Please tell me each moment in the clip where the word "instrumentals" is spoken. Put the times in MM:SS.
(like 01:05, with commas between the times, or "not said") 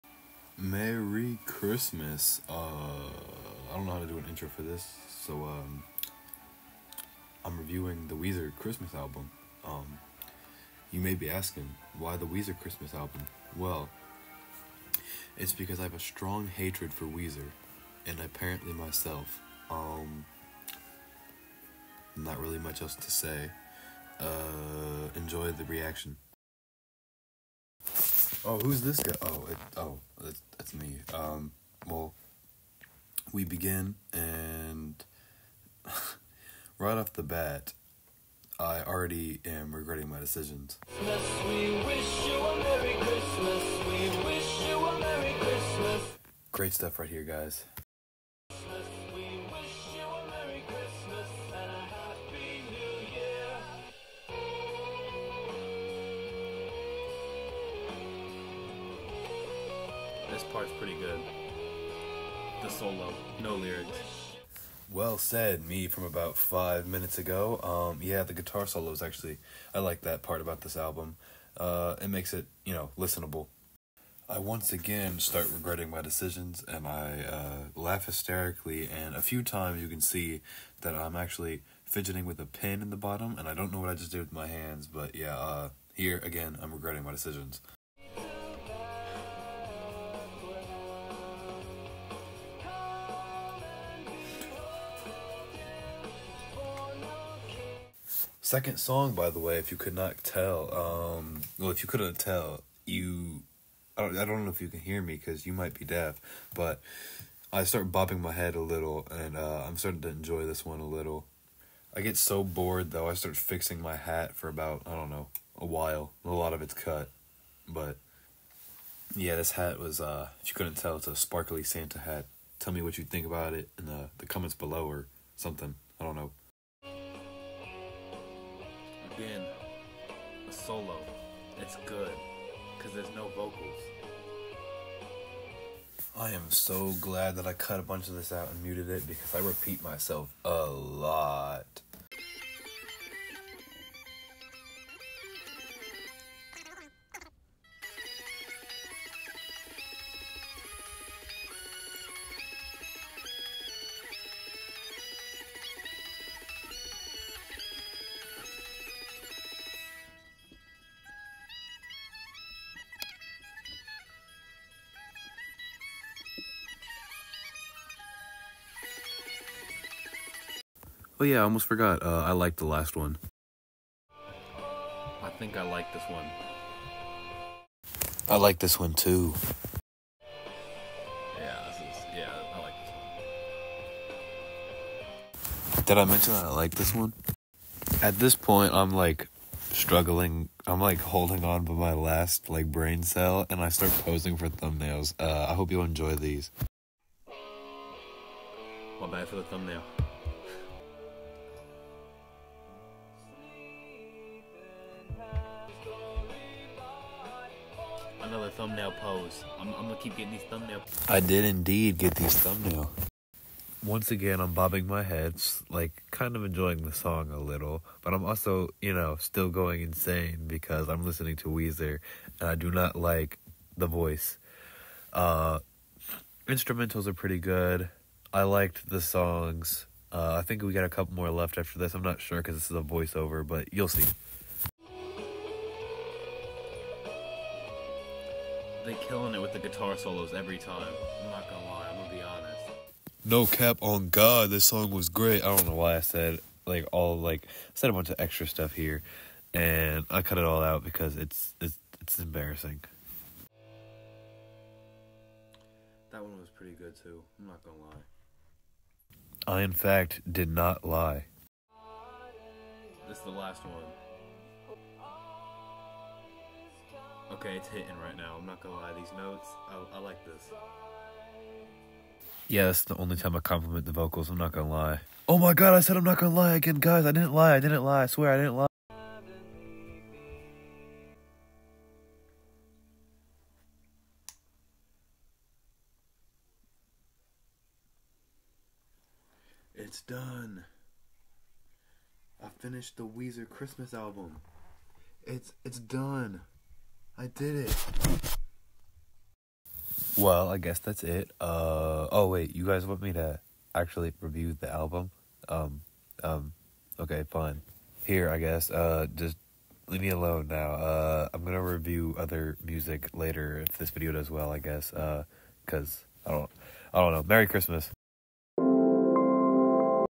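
03:46.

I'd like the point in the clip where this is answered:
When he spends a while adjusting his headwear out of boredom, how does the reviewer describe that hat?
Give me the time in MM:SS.
02:01.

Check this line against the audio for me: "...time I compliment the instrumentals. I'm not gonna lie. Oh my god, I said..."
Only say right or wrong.
wrong.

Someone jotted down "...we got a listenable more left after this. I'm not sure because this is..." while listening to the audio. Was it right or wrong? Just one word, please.
wrong.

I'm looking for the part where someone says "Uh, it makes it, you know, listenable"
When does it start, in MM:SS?
01:11.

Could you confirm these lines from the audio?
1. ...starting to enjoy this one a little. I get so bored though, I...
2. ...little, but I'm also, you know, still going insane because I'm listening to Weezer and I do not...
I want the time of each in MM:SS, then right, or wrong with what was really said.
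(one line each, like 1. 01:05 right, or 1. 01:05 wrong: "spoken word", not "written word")
1. 01:49 right
2. 03:37 right.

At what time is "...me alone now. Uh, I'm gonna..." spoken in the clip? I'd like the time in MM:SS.
05:10.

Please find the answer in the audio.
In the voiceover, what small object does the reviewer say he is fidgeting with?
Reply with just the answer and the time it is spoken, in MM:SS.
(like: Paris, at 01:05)
pin, at 01:22.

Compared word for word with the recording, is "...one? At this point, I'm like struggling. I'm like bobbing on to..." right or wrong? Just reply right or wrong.
wrong.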